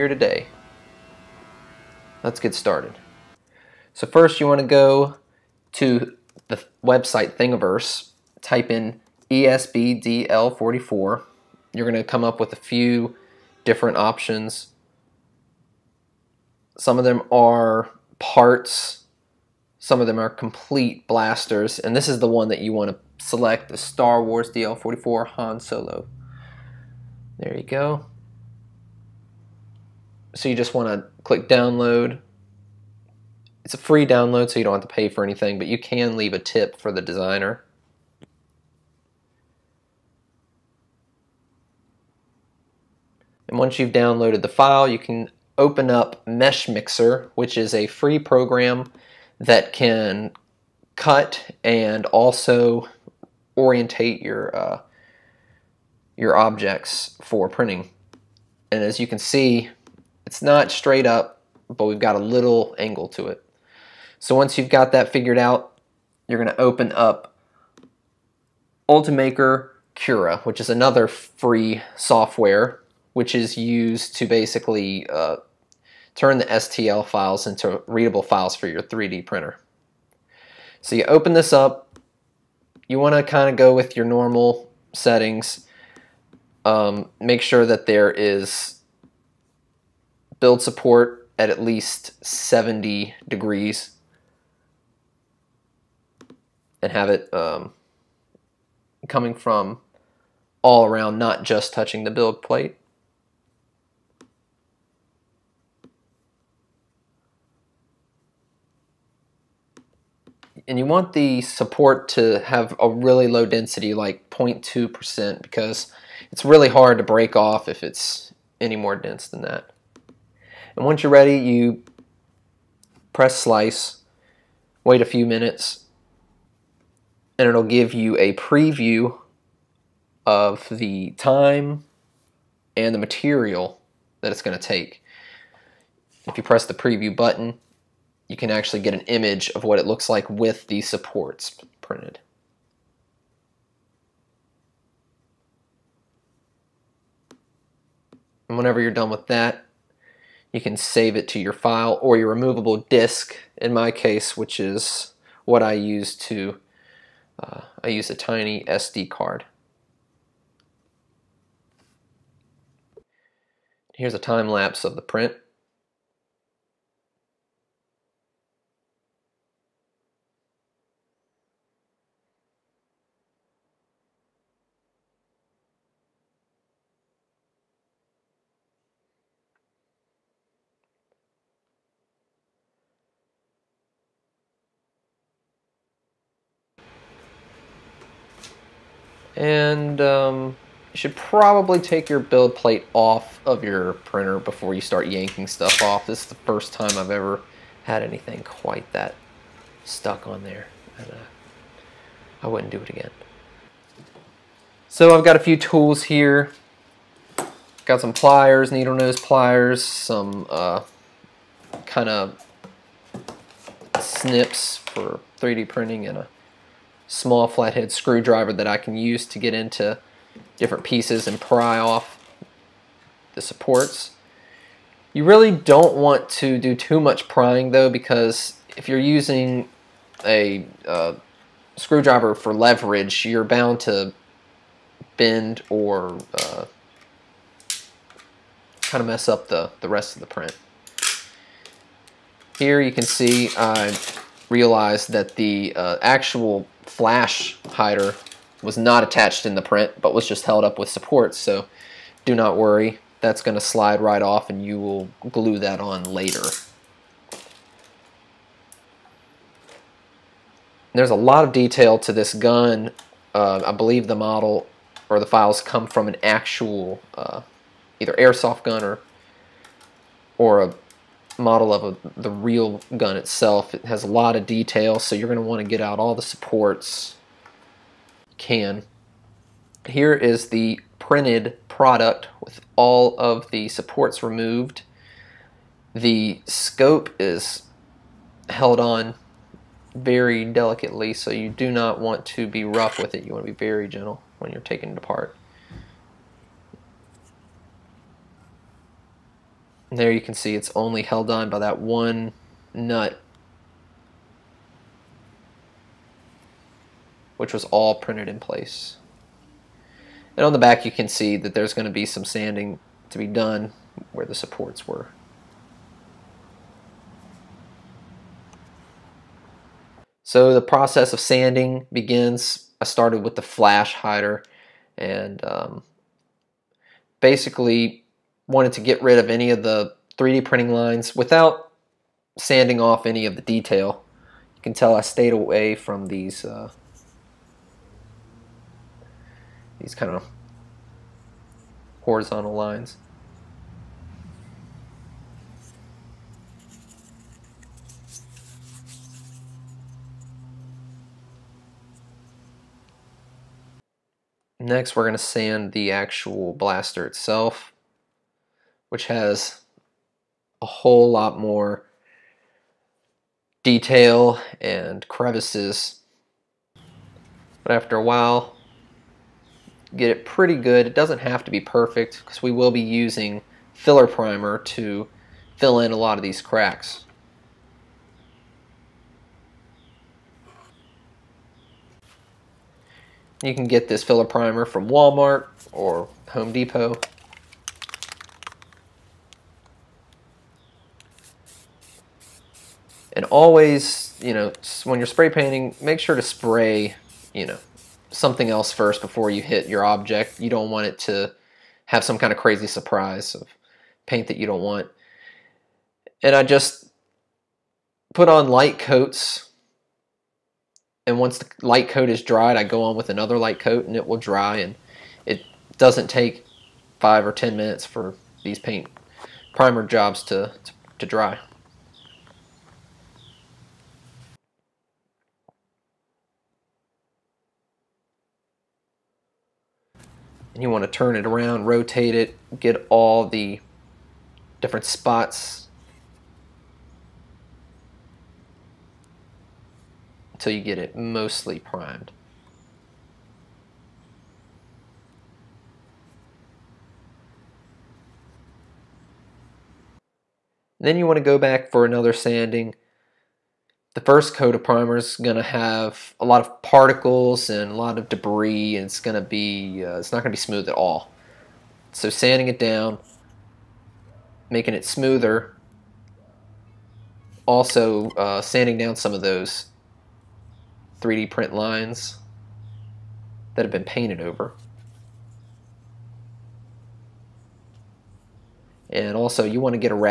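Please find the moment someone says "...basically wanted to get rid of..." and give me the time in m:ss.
5:27.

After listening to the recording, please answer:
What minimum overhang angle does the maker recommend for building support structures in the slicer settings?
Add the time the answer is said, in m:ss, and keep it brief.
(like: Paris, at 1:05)
70 degrees, at 1:32.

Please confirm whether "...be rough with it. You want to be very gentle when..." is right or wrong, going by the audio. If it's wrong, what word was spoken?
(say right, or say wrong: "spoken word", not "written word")
right.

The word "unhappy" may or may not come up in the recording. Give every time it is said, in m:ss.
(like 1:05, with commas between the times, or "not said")
not said.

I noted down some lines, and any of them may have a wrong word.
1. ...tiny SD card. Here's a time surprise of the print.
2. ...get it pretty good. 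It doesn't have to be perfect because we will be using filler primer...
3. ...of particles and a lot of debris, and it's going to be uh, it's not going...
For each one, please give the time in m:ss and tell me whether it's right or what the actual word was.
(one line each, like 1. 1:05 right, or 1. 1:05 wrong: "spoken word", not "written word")
1. 2:38 wrong: "lapse", not "surprise"
2. 6:09 right
3. 7:36 right.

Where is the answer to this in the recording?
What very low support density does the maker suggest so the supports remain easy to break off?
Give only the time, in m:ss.
1:54.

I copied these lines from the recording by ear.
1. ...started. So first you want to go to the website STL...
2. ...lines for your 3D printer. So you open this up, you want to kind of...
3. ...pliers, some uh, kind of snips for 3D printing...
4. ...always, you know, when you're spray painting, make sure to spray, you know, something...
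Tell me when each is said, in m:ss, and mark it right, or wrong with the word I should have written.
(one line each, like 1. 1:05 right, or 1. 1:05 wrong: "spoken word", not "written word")
1. 0:02 wrong: "Thingiverse", not "STL"
2. 1:18 wrong: "files", not "lines"
3. 3:29 right
4. 6:33 right.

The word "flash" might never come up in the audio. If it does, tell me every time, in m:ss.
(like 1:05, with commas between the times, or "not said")
4:06, 5:23.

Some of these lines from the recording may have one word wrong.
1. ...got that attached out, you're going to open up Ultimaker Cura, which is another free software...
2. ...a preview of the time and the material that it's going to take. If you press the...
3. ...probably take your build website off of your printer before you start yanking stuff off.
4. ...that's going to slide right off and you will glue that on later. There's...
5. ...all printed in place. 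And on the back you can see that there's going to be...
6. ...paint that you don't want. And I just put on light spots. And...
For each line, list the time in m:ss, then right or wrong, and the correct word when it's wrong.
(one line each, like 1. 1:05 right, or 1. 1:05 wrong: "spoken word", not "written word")
1. 1:04 wrong: "figured", not "attached"
2. 2:08 right
3. 3:11 wrong: "plate", not "website"
4. 4:13 right
5. 5:07 right
6. 6:44 wrong: "coats", not "spots".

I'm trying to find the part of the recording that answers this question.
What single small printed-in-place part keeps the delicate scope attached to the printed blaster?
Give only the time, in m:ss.
5:01.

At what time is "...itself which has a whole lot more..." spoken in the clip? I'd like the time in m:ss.
5:57.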